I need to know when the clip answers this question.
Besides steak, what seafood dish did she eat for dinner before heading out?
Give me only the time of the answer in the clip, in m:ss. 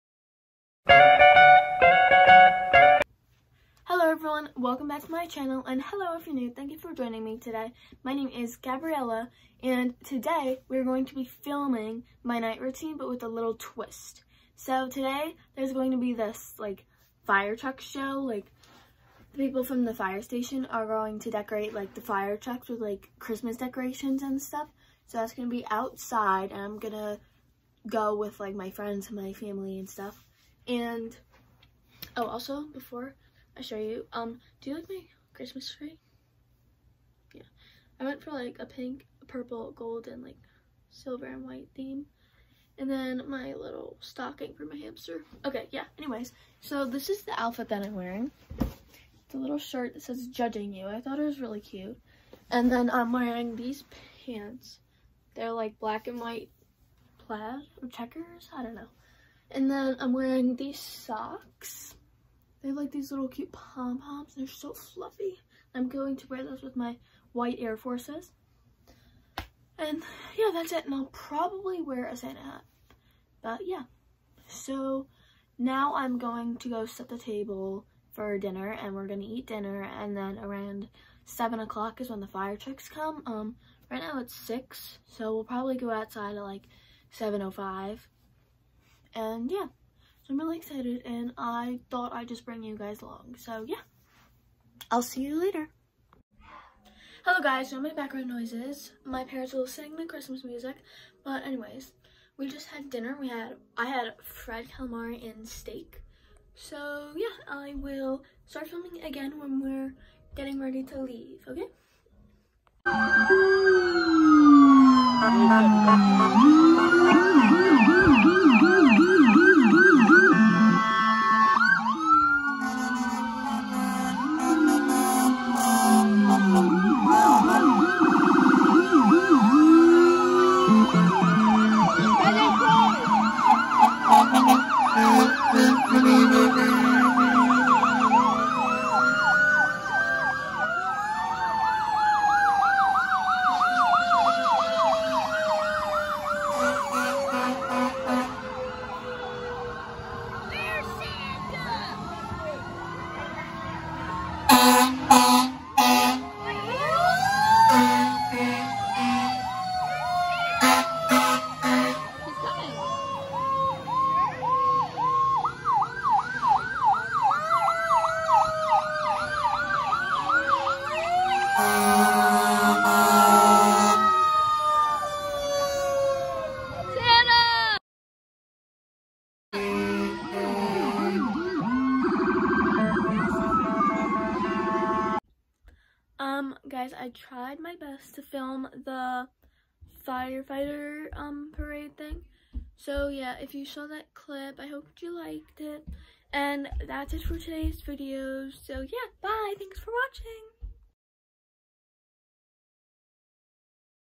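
1:44.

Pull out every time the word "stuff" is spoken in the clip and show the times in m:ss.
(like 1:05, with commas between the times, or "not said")
0:24, 0:29.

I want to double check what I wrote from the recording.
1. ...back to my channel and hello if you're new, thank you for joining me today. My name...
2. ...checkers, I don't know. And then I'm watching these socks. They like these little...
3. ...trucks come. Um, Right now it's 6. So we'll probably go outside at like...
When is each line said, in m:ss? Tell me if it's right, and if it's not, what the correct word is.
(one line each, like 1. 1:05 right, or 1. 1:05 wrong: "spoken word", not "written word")
1. 0:04 right
2. 0:57 wrong: "wearing", not "watching"
3. 1:22 right.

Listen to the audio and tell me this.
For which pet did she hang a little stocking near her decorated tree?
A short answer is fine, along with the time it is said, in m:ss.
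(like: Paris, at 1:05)
hamster, at 0:44.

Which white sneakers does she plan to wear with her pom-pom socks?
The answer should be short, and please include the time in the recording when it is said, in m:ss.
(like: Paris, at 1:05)
Air Forces, at 1:07.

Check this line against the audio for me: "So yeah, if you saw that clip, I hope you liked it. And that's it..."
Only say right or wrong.
right.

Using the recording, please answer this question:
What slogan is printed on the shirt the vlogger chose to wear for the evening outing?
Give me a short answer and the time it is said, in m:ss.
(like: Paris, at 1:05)
judging you, at 0:50.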